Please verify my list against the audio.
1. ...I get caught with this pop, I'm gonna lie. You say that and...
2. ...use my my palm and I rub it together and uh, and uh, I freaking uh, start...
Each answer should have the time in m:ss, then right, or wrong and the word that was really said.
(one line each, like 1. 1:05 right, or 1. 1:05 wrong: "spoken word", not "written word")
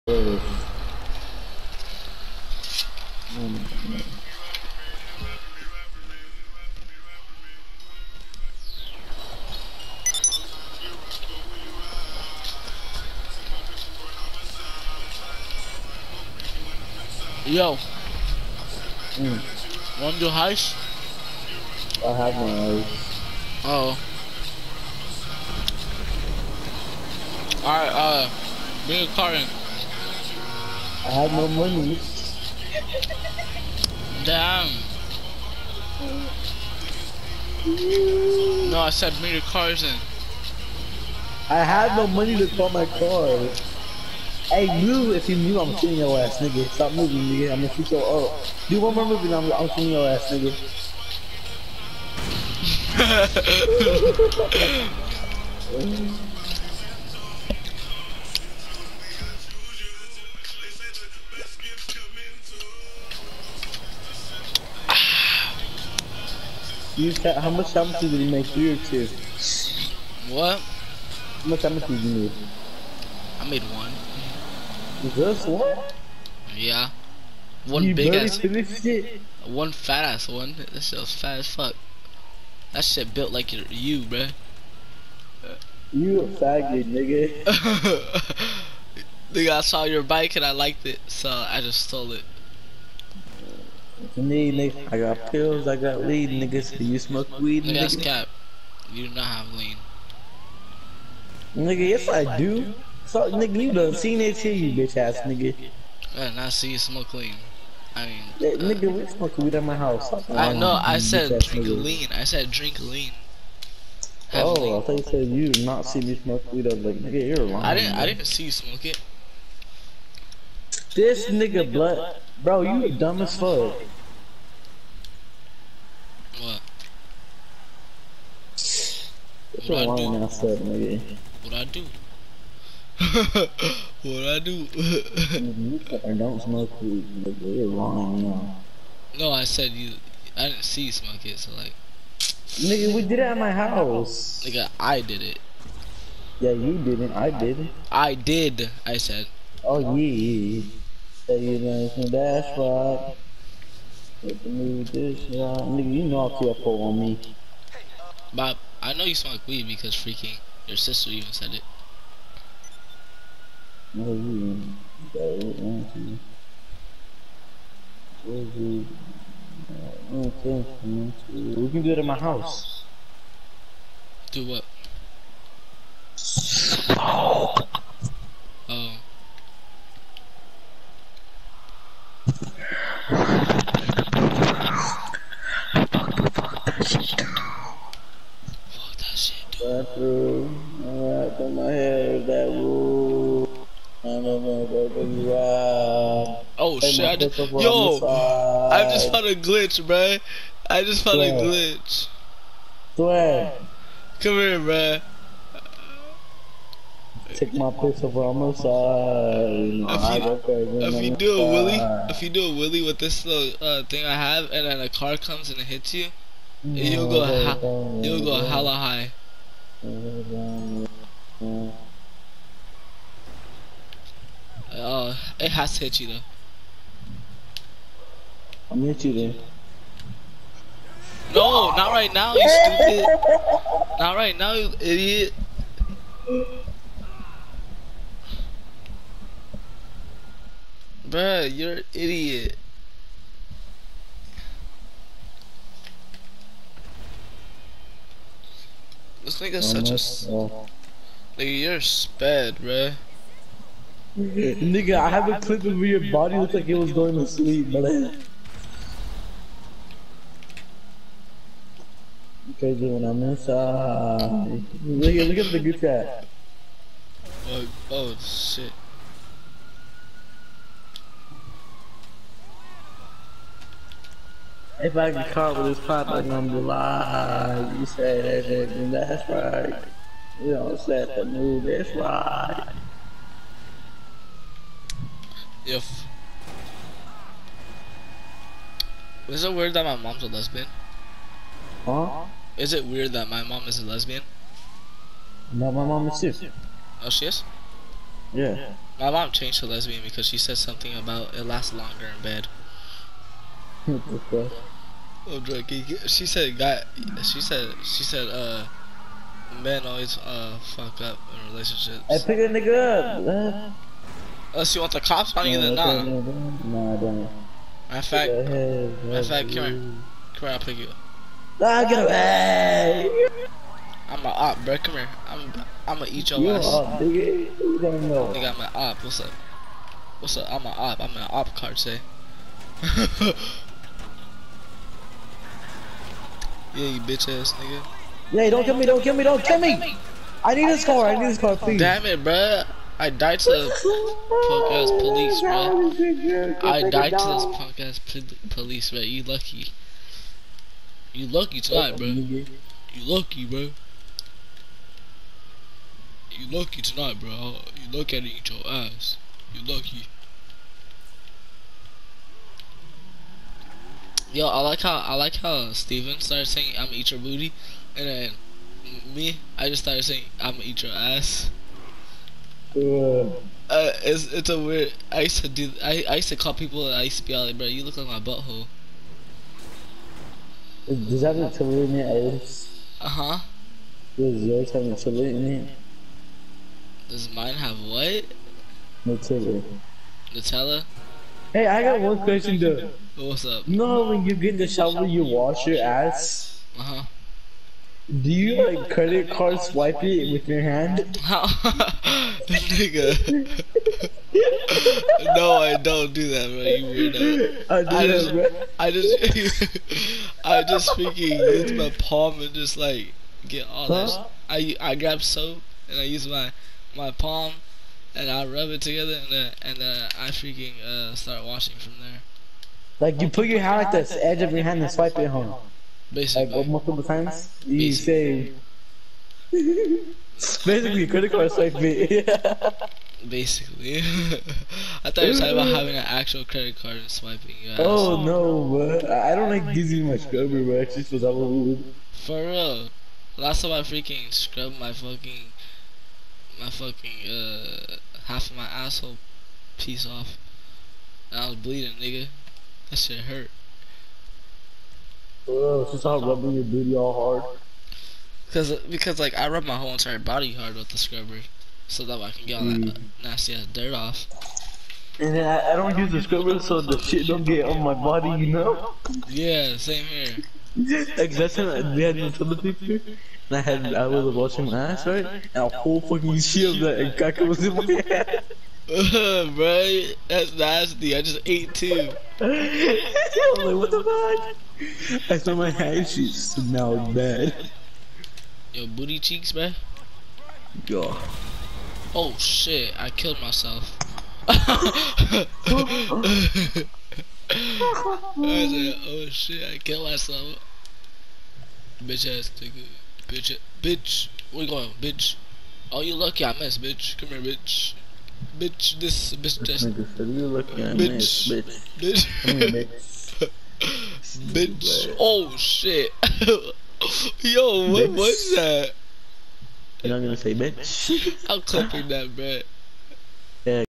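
1. 4:34 right
2. 6:56 right.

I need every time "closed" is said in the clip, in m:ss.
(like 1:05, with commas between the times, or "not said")
not said.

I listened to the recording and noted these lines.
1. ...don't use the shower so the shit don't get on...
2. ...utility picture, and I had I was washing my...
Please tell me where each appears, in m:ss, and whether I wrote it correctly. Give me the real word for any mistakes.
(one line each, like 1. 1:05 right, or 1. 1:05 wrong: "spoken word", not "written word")
1. 7:45 wrong: "scrubber", not "shower"
2. 7:52 right.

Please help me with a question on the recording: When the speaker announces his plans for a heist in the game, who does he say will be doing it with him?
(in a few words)
Karin.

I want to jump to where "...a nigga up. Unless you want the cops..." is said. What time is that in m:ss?
5:12.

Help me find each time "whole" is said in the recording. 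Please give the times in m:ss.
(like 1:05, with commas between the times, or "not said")
7:39, 7:55.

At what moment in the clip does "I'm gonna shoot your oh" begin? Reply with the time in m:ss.
0:47.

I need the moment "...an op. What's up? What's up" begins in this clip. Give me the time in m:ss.
5:28.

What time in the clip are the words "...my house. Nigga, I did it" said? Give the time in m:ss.
2:23.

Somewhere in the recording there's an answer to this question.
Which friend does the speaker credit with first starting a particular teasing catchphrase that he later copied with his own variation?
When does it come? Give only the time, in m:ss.
6:05.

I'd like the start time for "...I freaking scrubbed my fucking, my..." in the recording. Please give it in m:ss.
7:23.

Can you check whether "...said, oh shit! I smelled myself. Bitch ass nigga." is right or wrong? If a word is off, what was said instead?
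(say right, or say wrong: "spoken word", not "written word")
wrong: "killed", not "smelled".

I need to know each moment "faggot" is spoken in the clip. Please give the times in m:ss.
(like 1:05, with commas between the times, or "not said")
1:26.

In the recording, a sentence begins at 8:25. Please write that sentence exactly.
Oh, you lucky I missed, bitch.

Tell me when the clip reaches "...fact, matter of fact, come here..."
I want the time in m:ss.
5:18.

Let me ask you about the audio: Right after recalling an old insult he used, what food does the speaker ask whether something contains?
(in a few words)
chili.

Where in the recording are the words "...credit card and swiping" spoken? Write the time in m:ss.
7:16.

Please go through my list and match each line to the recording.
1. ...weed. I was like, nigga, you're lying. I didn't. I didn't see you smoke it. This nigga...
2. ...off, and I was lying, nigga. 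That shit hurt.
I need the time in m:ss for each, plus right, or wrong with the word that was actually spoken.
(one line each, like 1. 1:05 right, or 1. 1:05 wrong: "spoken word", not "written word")
1. 1:56 right
2. 7:30 wrong: "bleeding", not "lying".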